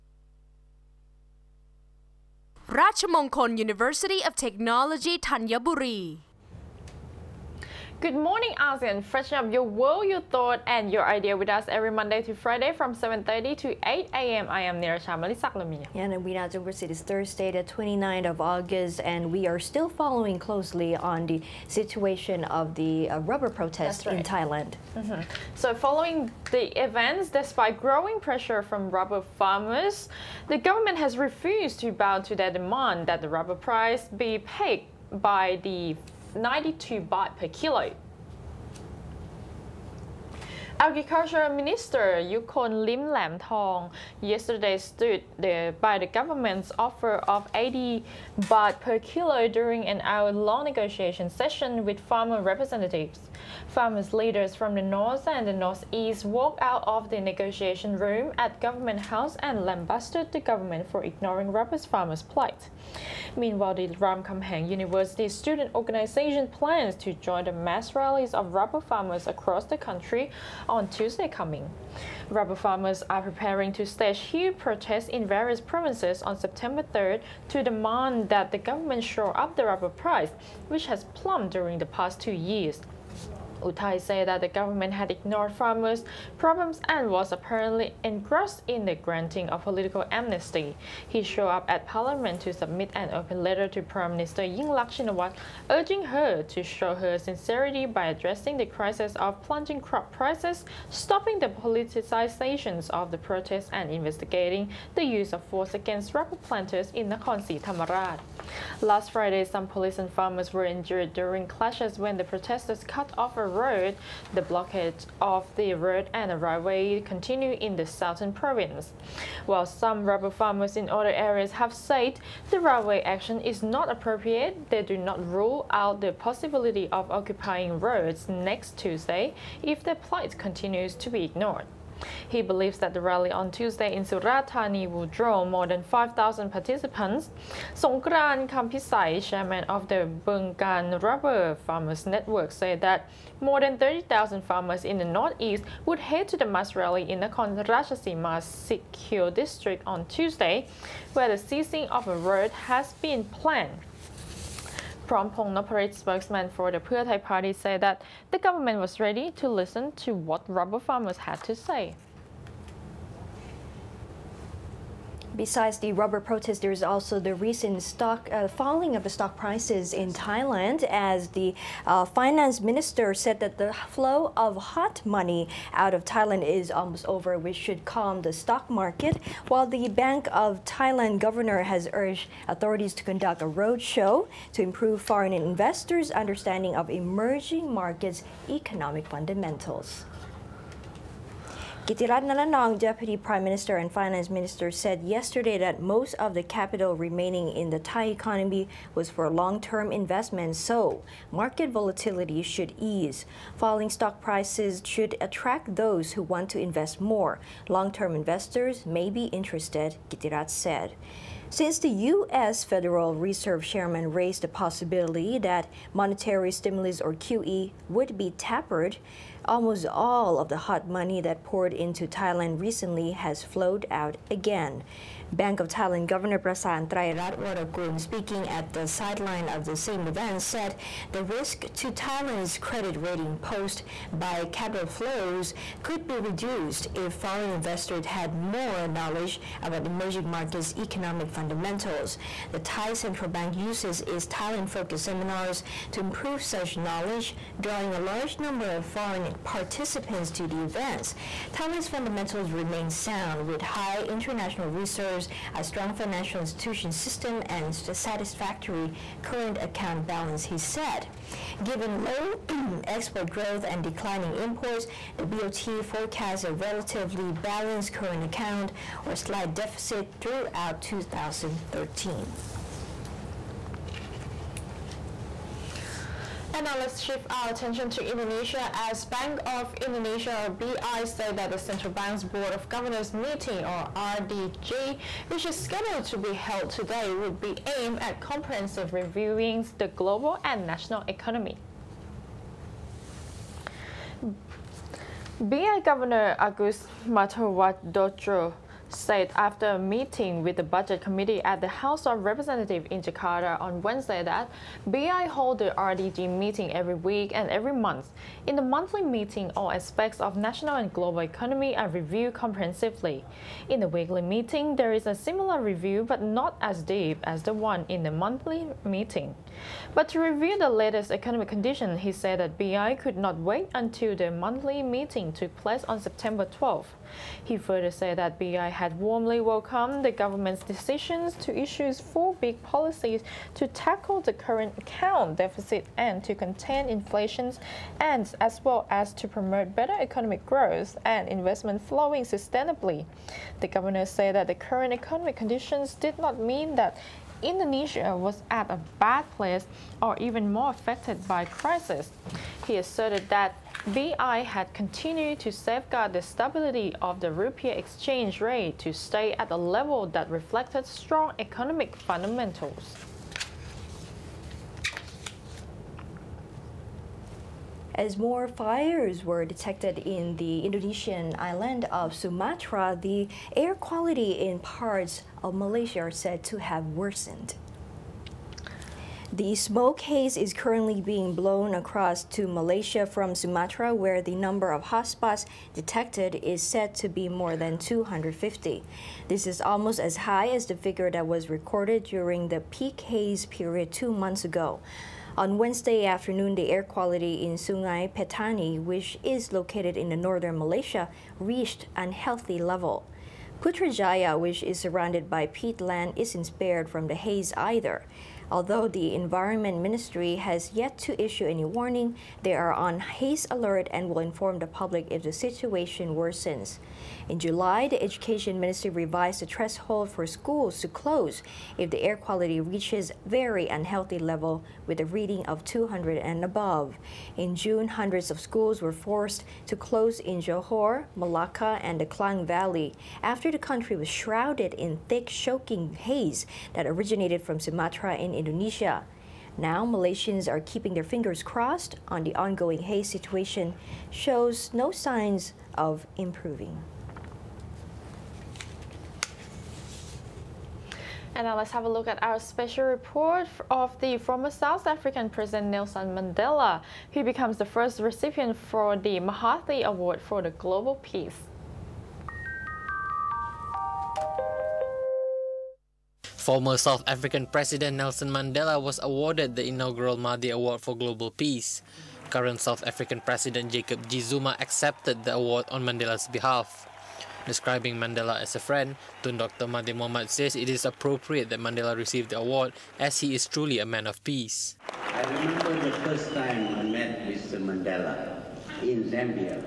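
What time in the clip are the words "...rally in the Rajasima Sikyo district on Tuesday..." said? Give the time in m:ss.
2:26.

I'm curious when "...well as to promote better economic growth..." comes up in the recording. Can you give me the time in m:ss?
5:38.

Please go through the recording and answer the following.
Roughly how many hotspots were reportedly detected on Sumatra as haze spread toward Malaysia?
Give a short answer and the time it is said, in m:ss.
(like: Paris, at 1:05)
more than 250, at 6:27.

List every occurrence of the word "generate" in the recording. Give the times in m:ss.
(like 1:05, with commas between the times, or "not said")
not said.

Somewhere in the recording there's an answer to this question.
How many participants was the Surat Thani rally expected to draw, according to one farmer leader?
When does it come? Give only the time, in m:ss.
2:15.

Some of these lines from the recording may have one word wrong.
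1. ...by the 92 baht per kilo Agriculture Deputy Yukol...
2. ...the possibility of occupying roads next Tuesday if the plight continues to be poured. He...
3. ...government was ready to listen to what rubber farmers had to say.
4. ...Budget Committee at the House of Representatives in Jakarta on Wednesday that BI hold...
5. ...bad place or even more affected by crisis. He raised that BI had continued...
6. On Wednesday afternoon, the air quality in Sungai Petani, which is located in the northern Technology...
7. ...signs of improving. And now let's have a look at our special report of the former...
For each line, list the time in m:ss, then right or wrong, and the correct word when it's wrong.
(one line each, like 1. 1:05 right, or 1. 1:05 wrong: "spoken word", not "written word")
1. 0:35 wrong: "Minister", not "Deputy"
2. 2:06 wrong: "ignored", not "poured"
3. 2:38 right
4. 5:00 right
5. 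5:49 wrong: "asserted", not "raised"
6. 6:35 wrong: "Malaysia", not "Technology"
7. 7:24 right.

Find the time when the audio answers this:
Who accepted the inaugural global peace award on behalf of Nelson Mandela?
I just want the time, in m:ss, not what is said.
7:53.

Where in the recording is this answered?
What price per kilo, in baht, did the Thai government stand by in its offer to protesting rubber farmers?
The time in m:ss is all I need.
0:47.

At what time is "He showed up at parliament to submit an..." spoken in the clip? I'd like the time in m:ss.
1:31.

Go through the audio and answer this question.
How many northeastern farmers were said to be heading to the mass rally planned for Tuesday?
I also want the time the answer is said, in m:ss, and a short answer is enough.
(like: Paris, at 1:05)
more than 30,000, at 2:23.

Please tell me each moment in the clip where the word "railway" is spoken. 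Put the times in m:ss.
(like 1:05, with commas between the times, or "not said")
1:56, 2:02.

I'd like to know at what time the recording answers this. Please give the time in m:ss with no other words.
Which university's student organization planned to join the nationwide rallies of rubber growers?
1:03.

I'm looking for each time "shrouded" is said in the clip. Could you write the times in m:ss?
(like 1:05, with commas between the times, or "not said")
7:14.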